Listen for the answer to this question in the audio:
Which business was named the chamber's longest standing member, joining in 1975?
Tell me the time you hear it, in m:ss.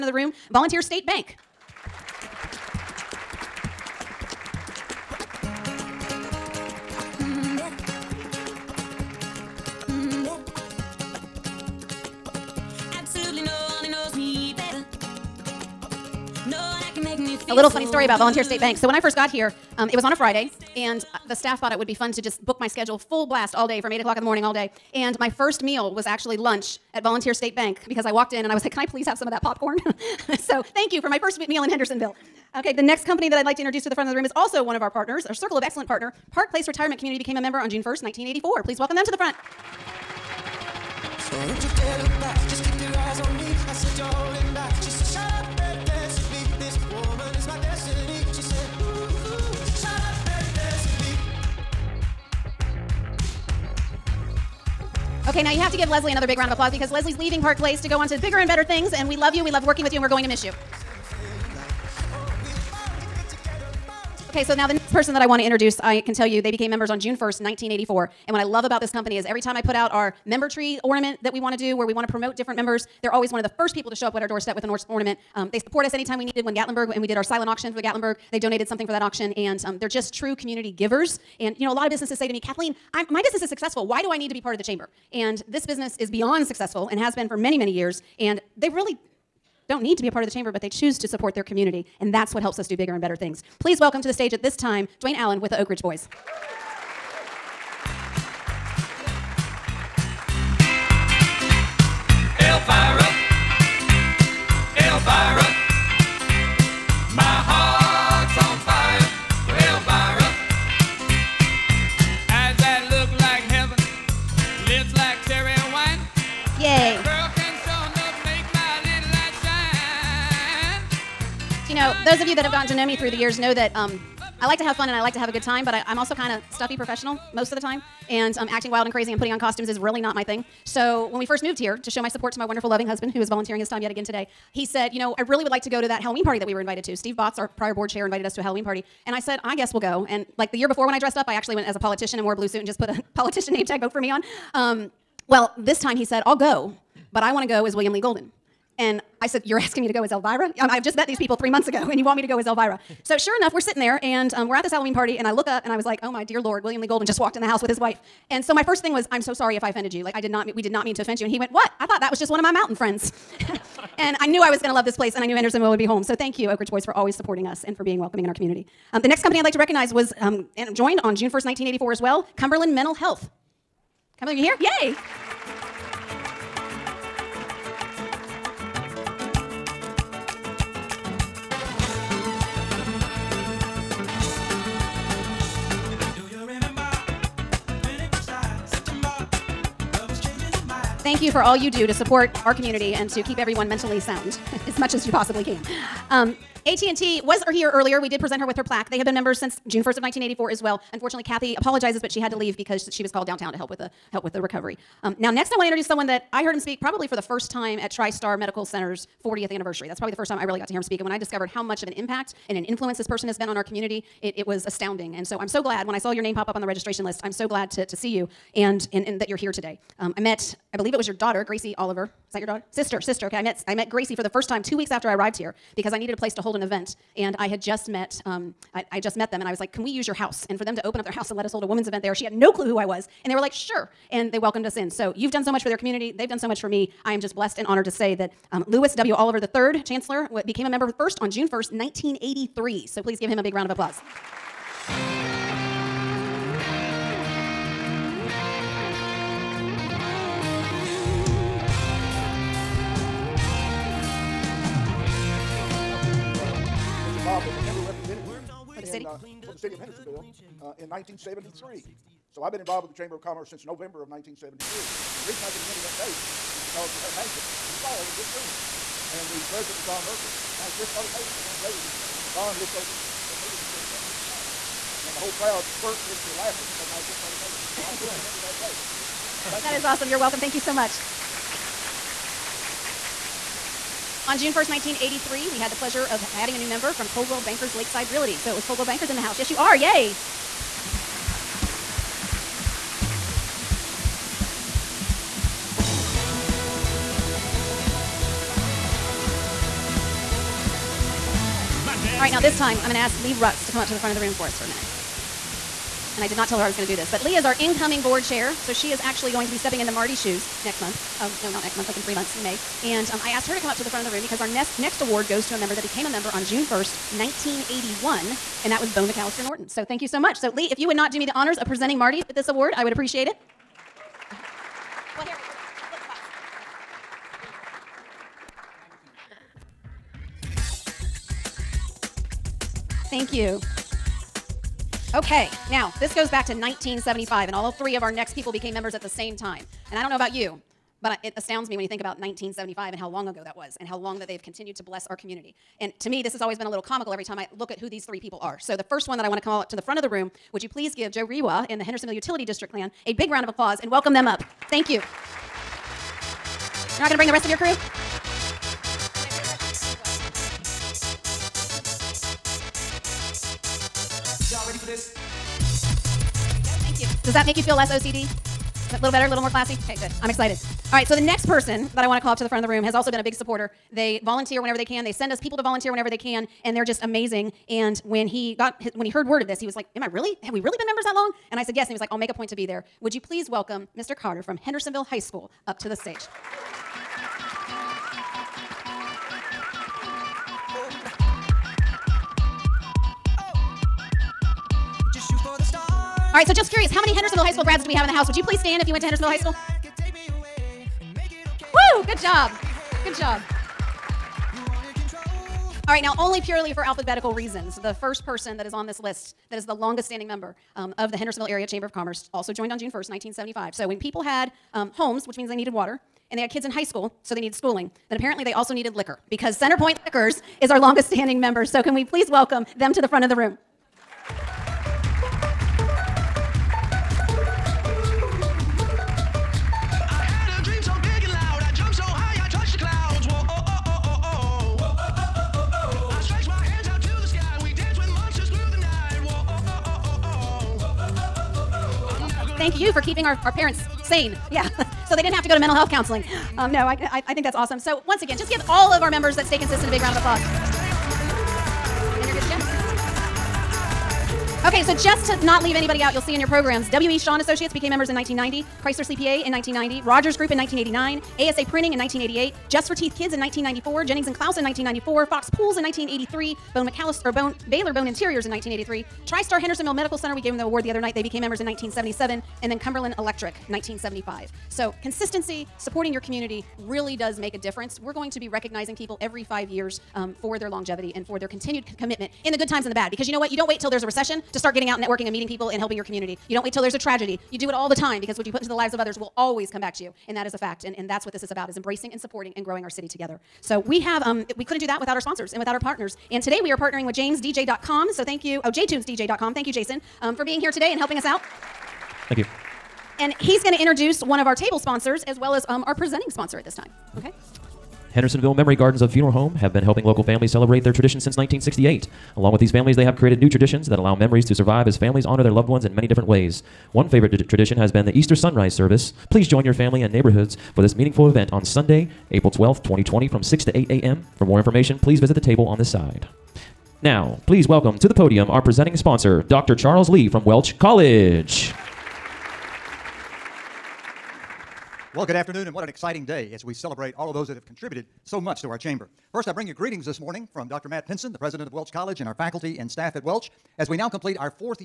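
6:59.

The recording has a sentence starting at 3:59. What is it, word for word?
Oliver III, Chancellor, became a member first on June 1st, 1983.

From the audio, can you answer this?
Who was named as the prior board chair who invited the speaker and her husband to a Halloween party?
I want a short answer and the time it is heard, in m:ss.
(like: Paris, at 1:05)
Steve Botts, at 2:16.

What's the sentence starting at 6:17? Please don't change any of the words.
And when he got his, when he heard word of this, he was like, "Am I really?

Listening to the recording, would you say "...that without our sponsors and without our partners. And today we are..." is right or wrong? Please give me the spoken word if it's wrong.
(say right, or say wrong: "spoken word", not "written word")
right.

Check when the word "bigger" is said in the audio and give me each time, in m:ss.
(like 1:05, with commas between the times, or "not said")
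0:58, 1:32.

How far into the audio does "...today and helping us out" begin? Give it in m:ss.
8:20.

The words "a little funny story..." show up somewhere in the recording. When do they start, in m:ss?
0:17.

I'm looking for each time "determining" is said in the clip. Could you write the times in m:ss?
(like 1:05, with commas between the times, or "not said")
not said.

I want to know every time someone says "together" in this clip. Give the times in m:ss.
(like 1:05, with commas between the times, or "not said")
8:13.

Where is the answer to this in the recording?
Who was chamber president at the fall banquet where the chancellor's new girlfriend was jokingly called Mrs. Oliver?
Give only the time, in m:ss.
4:29.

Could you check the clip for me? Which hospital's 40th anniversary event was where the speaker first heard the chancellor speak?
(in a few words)
TriStar Medical Center.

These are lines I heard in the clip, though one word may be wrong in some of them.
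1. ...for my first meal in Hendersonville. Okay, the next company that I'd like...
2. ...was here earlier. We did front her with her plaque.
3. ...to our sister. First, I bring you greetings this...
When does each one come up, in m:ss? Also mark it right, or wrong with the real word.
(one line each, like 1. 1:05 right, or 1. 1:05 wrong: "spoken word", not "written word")
1. 0:31 right
2. 3:17 wrong: "present", not "front"
3. 8:58 wrong: "chamber", not "sister".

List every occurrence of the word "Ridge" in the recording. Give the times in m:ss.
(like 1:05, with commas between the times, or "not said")
1:35, 2:46.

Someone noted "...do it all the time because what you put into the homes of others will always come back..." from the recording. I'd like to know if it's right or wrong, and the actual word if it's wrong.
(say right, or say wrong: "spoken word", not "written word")
wrong: "lives", not "homes".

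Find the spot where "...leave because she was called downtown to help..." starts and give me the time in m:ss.
3:22.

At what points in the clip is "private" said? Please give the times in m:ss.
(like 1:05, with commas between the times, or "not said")
not said.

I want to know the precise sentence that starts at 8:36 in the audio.
One favorite tradition has been the Easter sunrise service.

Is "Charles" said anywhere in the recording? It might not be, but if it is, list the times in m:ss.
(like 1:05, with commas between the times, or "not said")
8:49.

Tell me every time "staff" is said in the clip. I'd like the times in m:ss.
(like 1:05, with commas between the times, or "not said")
0:21, 9:02.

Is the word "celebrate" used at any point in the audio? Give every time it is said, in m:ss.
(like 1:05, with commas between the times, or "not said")
8:30, 8:56.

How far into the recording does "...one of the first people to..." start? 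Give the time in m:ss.
1:13.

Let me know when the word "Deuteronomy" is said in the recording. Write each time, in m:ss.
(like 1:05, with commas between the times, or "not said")
not said.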